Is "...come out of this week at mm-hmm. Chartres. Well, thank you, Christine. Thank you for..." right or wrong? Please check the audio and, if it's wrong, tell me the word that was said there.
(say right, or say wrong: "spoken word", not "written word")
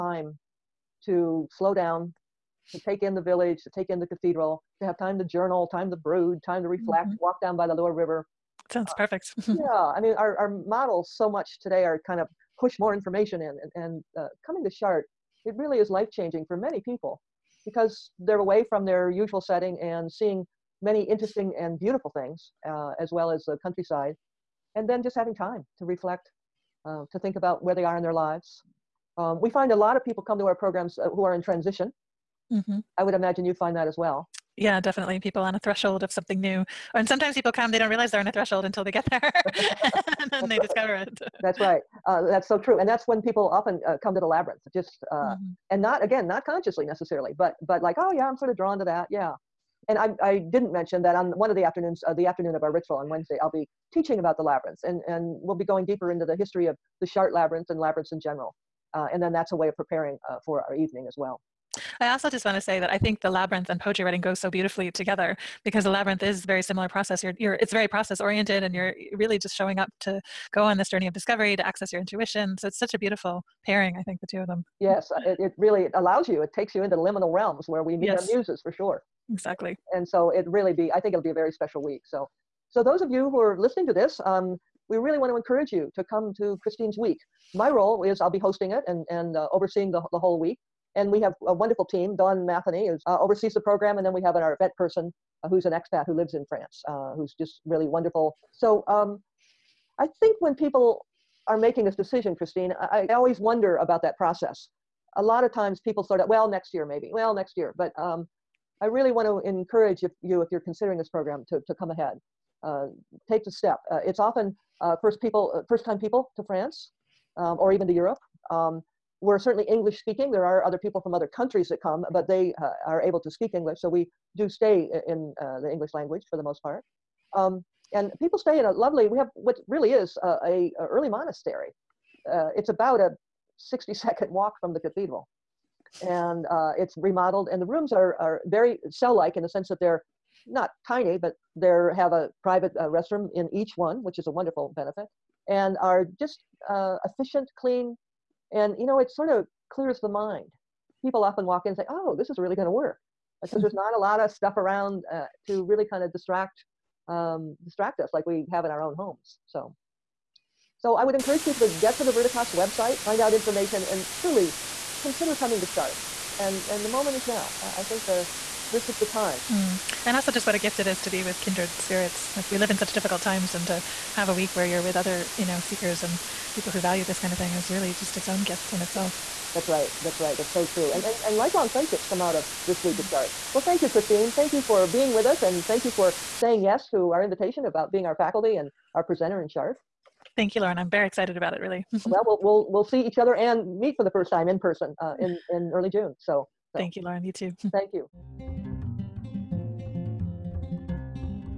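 right.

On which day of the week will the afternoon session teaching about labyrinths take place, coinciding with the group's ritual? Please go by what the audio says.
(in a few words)
Wednesday.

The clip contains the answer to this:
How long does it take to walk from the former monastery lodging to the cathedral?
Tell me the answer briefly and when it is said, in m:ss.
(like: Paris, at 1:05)
60 seconds, at 2:13.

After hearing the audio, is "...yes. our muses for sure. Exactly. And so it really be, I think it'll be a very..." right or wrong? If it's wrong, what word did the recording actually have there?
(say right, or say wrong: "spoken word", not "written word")
right.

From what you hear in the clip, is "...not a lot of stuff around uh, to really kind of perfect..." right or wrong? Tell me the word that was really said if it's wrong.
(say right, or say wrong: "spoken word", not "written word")
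wrong: "distract", not "perfect".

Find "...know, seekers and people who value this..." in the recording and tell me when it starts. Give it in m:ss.
2:55.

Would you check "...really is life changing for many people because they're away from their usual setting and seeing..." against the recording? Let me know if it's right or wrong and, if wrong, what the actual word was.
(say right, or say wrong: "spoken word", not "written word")
right.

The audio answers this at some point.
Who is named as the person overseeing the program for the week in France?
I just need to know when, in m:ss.
1:32.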